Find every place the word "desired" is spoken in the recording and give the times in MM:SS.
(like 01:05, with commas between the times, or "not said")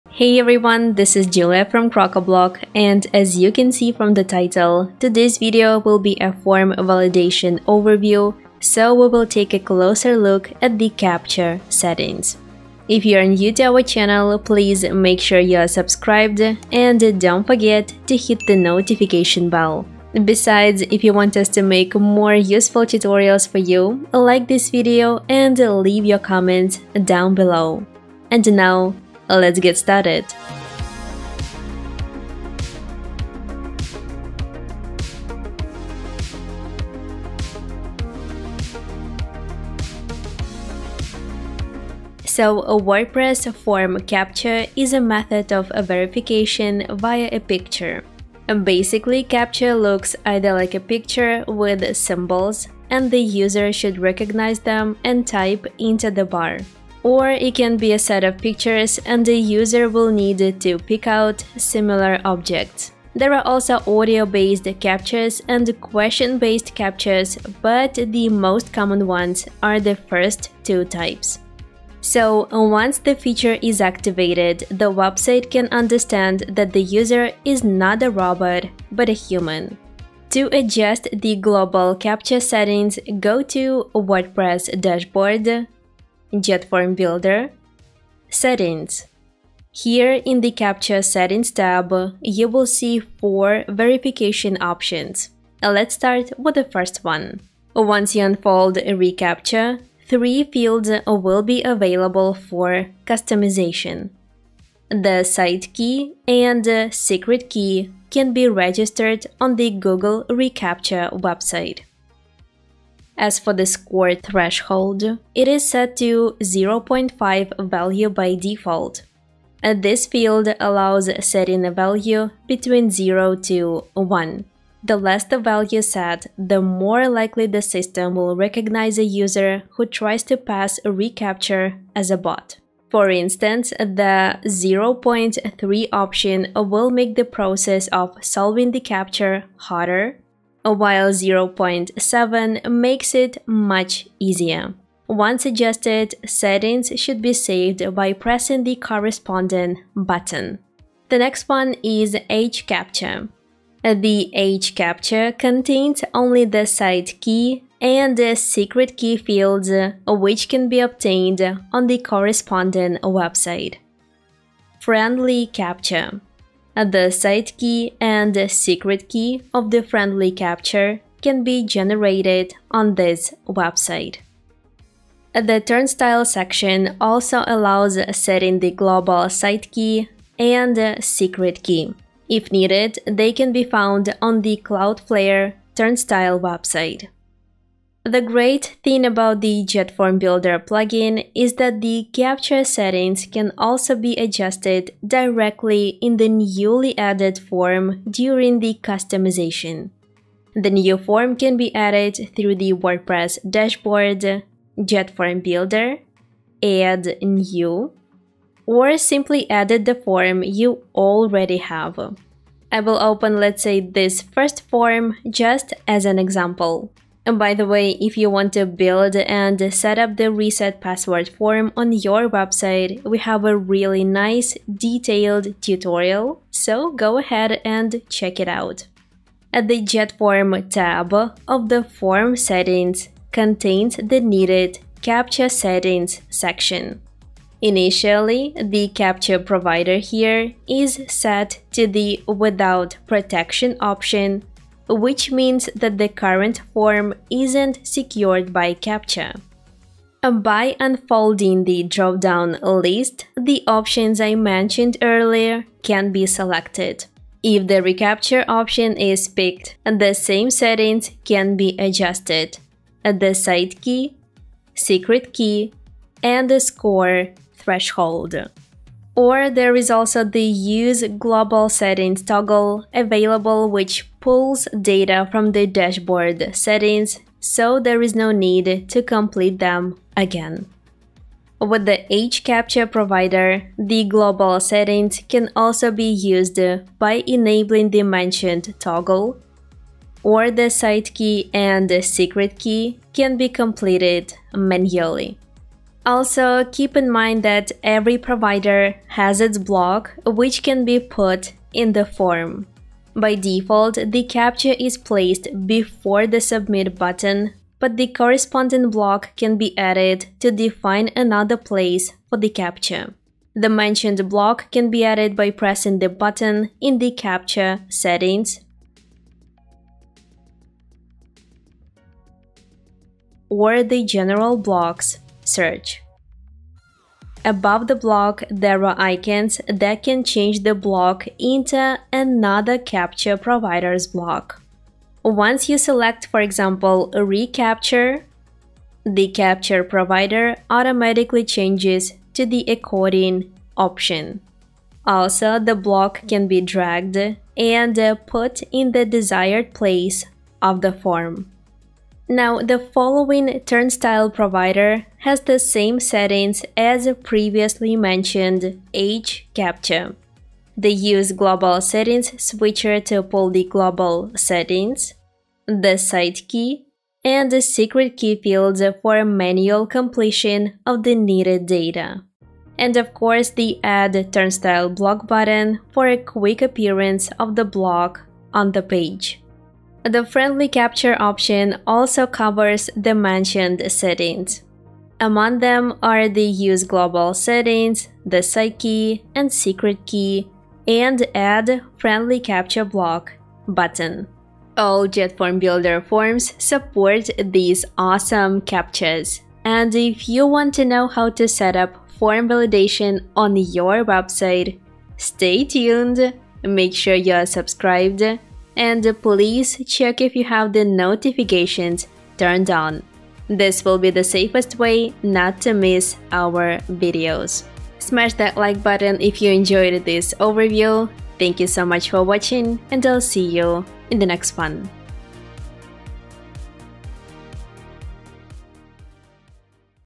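05:49.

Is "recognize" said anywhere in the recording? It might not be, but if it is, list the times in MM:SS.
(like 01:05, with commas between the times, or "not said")
00:53, 02:08.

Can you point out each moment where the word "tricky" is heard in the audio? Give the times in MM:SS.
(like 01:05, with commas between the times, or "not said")
not said.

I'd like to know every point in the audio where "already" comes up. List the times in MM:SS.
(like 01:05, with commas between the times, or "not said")
03:30.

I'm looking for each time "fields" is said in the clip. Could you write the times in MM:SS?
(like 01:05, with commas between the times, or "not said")
01:40, 02:00, 02:39, 06:08.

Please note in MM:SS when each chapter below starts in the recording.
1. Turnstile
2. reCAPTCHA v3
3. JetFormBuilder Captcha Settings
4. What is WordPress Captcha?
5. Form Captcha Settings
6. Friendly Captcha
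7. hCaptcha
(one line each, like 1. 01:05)
1. 02:56
2. 01:37
3. 01:21
4. 00:41
5. 03:09
6. 02:44
7. 02:31.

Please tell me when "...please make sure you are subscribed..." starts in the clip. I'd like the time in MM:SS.
00:14.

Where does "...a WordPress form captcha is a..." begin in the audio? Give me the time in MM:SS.
00:42.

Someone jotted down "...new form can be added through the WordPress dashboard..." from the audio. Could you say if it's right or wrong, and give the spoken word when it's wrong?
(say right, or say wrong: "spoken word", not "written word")
right.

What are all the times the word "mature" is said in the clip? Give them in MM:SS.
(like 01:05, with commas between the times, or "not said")
not said.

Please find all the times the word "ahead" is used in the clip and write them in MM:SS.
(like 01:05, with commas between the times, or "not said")
03:47.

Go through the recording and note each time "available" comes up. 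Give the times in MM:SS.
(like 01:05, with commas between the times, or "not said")
01:41, 04:32.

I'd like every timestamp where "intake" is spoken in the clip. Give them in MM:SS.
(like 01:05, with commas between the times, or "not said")
not said.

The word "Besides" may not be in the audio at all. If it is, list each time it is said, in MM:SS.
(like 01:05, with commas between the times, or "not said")
00:20.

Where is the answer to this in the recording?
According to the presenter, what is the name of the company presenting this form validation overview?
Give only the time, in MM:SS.
00:01.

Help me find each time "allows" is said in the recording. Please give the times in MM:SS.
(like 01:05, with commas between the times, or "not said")
02:00, 02:57.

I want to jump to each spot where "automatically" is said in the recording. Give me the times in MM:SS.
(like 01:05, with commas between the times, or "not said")
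05:40.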